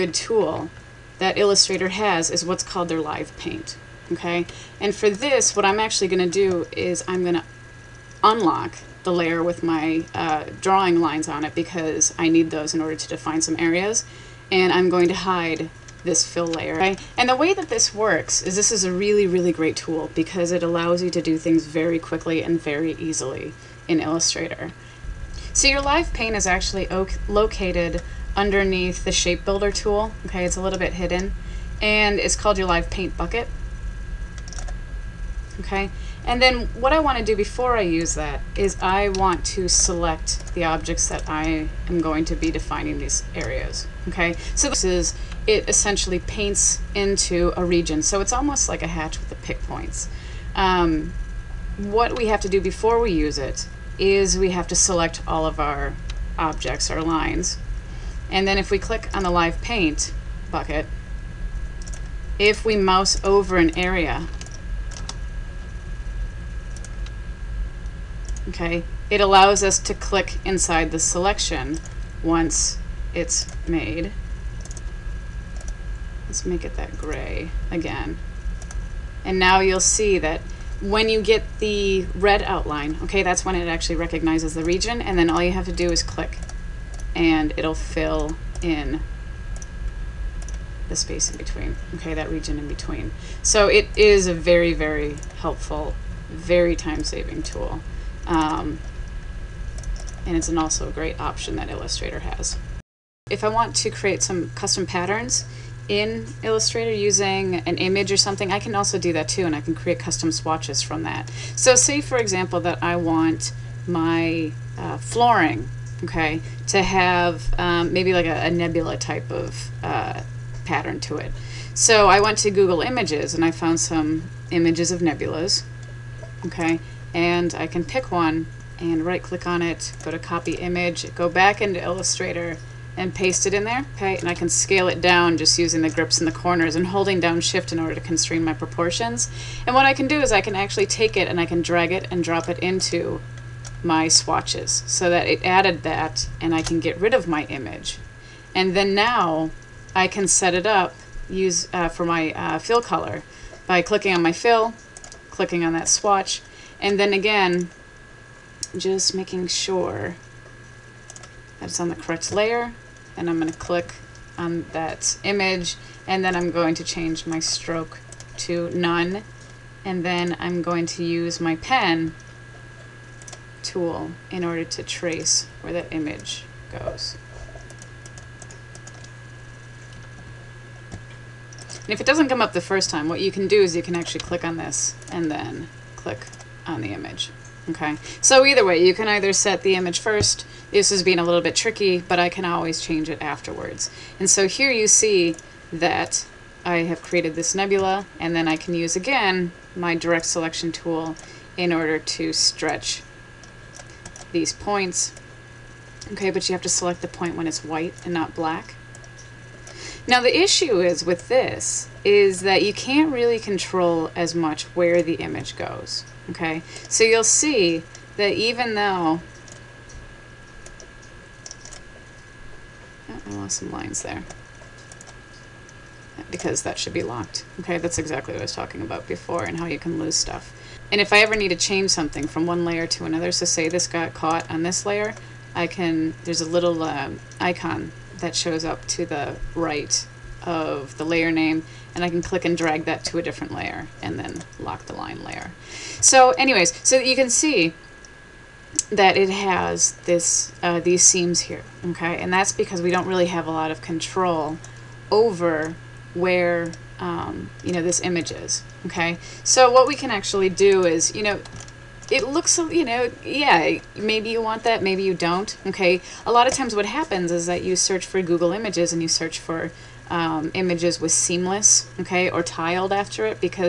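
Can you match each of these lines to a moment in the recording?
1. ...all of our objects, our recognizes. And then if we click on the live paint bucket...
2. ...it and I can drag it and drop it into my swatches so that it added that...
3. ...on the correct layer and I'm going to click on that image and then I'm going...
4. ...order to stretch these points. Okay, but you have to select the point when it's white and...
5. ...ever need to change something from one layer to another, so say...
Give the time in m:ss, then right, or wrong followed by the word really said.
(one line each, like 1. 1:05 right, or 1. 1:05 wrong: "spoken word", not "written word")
1. 0:55 wrong: "lines", not "recognizes"
2. 2:21 right
3. 2:41 right
4. 3:21 right
5. 3:51 right.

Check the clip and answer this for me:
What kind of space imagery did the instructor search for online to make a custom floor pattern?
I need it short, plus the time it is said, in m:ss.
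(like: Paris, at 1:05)
nebulas, at 2:04.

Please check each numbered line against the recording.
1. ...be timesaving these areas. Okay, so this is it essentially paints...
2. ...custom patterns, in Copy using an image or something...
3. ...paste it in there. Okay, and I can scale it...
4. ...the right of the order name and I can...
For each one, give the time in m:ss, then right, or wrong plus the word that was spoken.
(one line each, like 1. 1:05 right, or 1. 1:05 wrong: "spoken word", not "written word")
1. 0:42 wrong: "defining", not "timesaving"
2. 1:44 wrong: "Illustrator", not "Copy"
3. 2:13 right
4. 3:59 wrong: "layer", not "order".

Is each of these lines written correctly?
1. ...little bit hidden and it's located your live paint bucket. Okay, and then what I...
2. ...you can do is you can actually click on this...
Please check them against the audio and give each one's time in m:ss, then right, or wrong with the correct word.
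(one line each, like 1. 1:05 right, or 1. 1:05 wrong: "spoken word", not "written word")
1. 0:30 wrong: "called", not "located"
2. 3:03 right.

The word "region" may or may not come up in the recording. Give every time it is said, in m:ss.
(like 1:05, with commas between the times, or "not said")
0:47, 1:24, 1:32.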